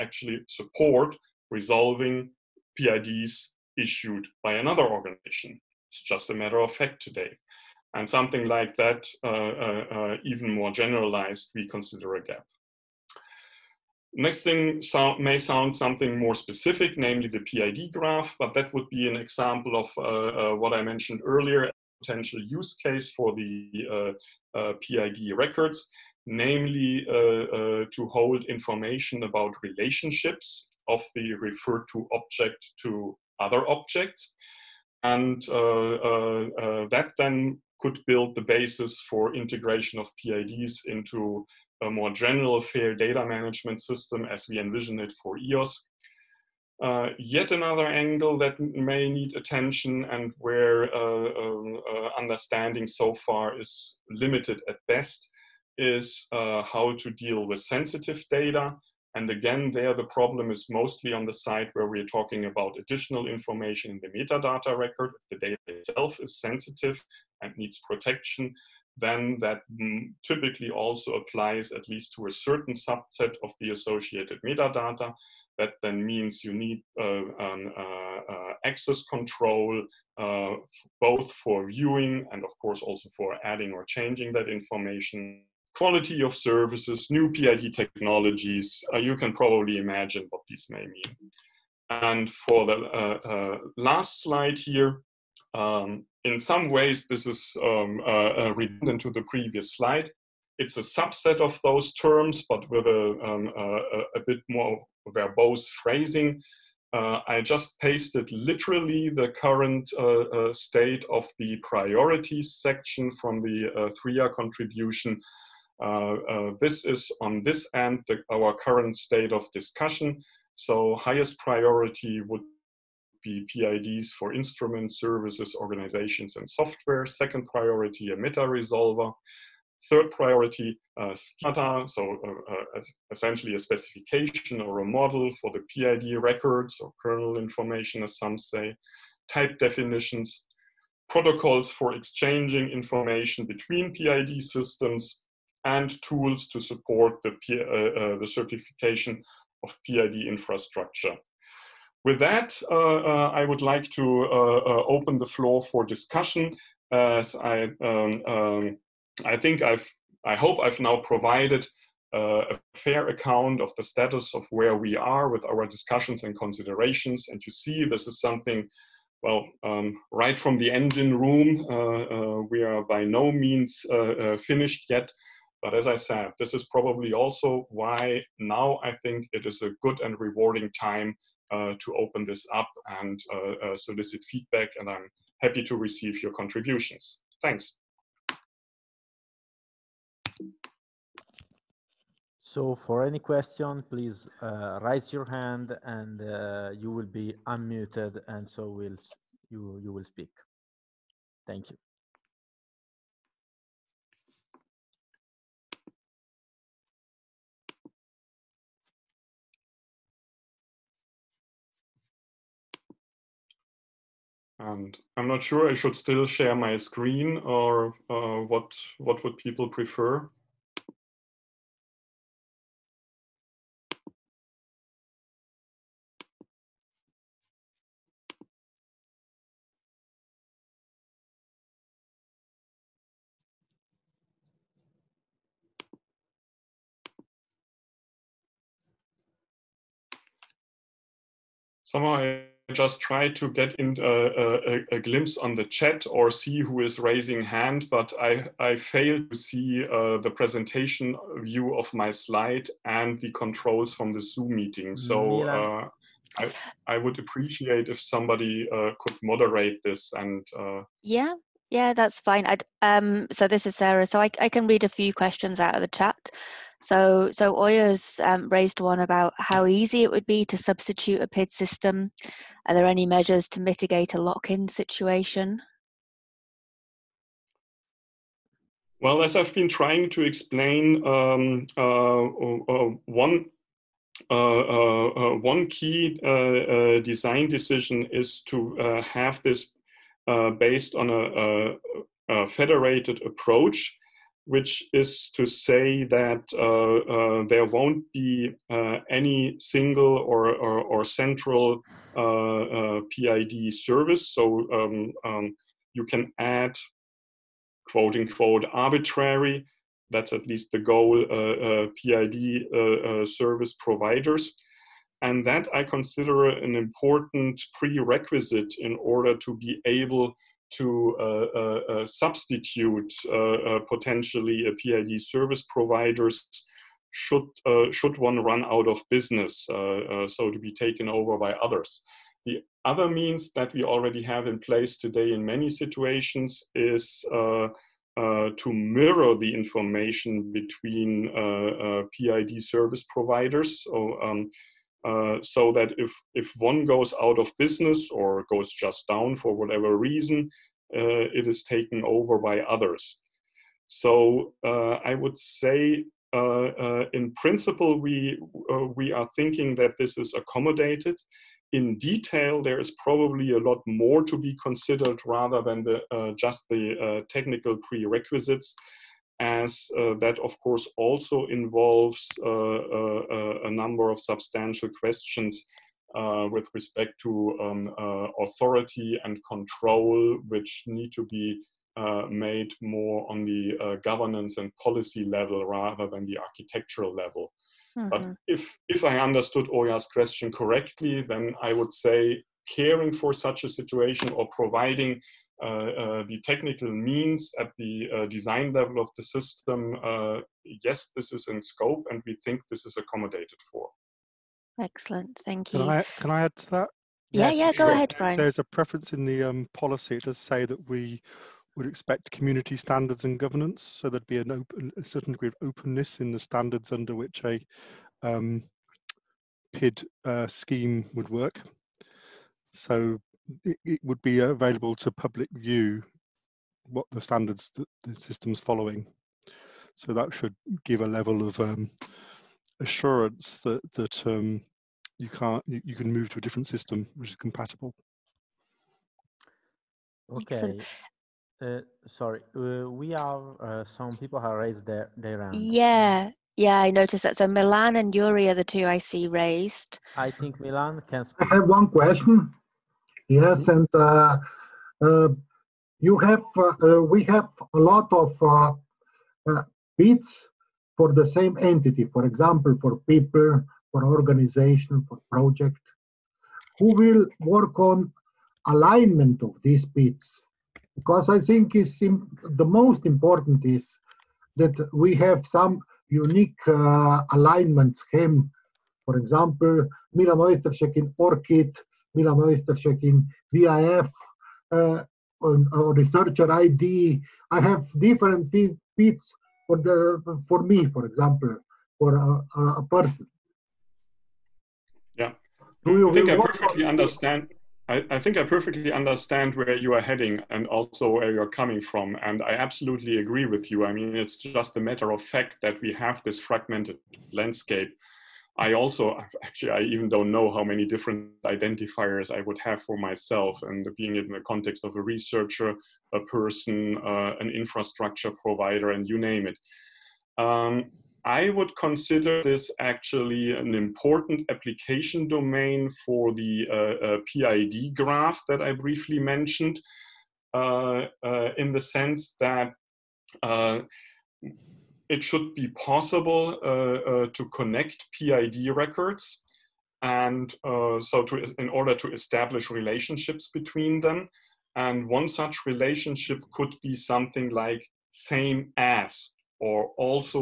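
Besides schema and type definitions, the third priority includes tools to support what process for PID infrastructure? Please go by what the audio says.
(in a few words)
certification.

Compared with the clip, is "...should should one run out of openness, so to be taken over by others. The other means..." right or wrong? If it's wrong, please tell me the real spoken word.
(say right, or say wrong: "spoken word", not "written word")
wrong: "business", not "openness".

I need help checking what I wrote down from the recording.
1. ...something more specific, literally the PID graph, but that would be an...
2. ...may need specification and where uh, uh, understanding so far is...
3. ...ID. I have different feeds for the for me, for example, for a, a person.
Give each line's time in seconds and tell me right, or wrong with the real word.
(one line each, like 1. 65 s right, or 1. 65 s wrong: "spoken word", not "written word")
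1. 15 s wrong: "namely", not "literally"
2. 48 s wrong: "attention", not "specification"
3. 486 s right.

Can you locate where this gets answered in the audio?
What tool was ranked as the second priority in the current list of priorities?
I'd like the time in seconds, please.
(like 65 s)
128 s.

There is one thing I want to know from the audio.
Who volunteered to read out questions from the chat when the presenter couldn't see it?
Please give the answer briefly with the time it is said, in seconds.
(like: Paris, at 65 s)
Sarah, at 263 s.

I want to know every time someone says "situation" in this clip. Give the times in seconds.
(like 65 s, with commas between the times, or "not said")
274 s, 335 s, 393 s.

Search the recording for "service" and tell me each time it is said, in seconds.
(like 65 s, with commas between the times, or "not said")
86 s, 124 s, 303 s, 313 s, 325 s, 342 s.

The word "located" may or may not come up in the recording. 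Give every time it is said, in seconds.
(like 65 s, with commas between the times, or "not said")
not said.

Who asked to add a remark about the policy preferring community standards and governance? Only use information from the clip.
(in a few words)
Brian.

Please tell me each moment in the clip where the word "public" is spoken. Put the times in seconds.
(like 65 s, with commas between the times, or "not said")
425 s.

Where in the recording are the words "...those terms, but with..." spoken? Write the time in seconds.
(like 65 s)
101 s.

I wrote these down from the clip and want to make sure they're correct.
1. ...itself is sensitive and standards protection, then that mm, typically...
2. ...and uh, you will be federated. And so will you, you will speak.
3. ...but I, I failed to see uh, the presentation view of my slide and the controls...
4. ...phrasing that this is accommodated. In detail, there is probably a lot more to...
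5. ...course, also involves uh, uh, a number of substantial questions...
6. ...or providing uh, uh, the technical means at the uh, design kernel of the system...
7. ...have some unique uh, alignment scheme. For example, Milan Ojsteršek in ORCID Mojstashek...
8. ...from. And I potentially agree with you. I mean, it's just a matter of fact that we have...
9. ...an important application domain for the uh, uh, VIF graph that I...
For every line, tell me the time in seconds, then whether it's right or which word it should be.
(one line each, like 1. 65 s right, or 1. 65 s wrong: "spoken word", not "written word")
1. 65 s wrong: "needs", not "standards"
2. 195 s wrong: "unmuted", not "federated"
3. 247 s right
4. 359 s wrong: "thinking", not "phrasing"
5. 370 s right
6. 394 s wrong: "level", not "kernel"
7. 475 s wrong: "Mila", not "Mojstashek"
8. 501 s wrong: "absolutely", not "potentially"
9. 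523 s wrong: "PID", not "VIF".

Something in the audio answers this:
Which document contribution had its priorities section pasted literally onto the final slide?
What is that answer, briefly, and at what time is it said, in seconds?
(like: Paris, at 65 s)
SRIA, at 113 s.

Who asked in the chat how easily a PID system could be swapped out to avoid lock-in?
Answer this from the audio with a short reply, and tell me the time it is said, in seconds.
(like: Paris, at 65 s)
Oyers, at 267 s.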